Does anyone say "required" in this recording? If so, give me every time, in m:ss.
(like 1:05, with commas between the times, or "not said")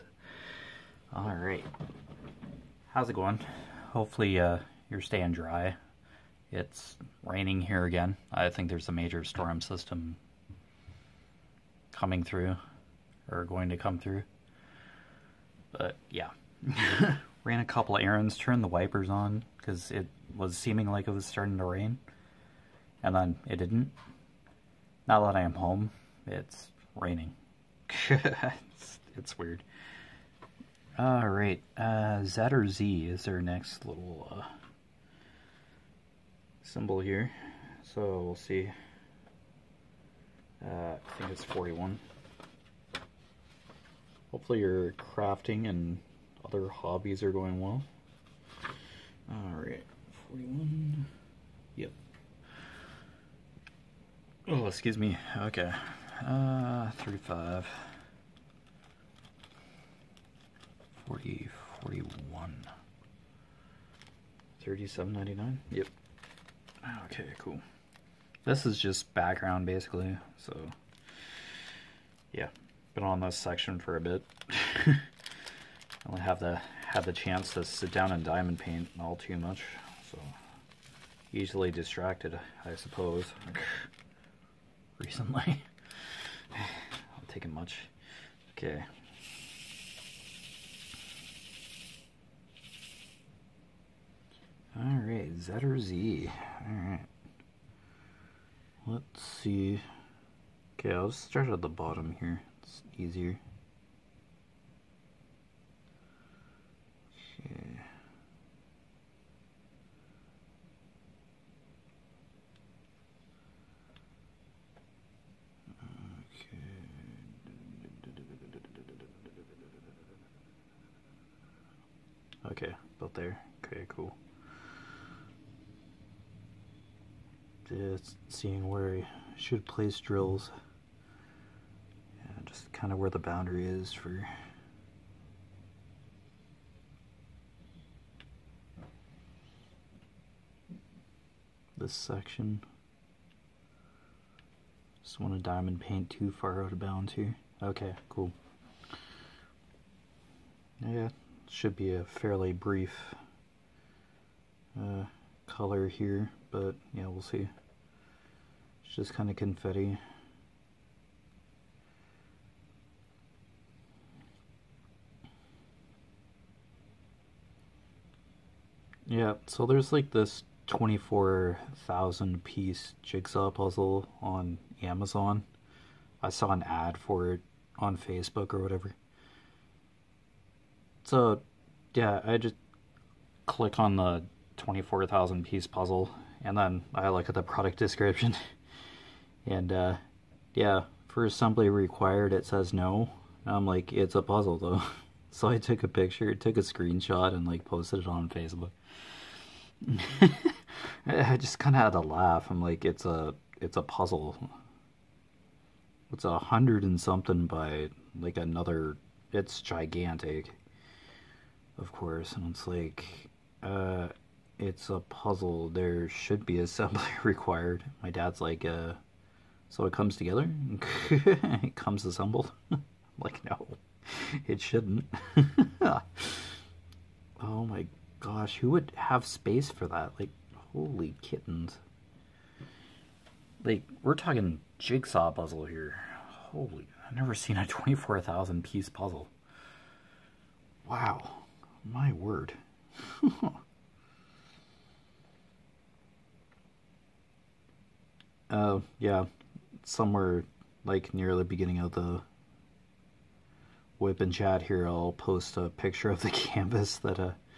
3:11, 3:37.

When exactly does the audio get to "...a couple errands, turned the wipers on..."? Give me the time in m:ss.
0:17.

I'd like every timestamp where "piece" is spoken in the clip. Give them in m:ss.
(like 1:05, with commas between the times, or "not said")
2:52, 3:05, 3:58.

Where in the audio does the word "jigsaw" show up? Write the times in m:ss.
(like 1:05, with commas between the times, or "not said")
2:53, 3:54.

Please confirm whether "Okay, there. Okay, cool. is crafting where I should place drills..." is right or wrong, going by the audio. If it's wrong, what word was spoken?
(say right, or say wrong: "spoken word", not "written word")
wrong: "seeing", not "crafting".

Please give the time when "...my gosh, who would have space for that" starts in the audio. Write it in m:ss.
3:47.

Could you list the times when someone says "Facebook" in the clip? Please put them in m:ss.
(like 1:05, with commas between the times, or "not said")
2:57, 3:18.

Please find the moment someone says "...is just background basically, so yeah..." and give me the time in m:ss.
1:08.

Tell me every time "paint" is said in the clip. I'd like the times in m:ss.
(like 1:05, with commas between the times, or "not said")
1:18, 2:25.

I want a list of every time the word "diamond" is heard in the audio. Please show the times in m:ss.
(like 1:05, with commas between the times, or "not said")
1:18, 2:25.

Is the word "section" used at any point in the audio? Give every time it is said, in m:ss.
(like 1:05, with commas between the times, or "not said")
1:13, 2:21.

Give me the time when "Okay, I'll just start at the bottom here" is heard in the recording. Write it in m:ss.
1:40.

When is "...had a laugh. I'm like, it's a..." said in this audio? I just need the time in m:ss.
3:21.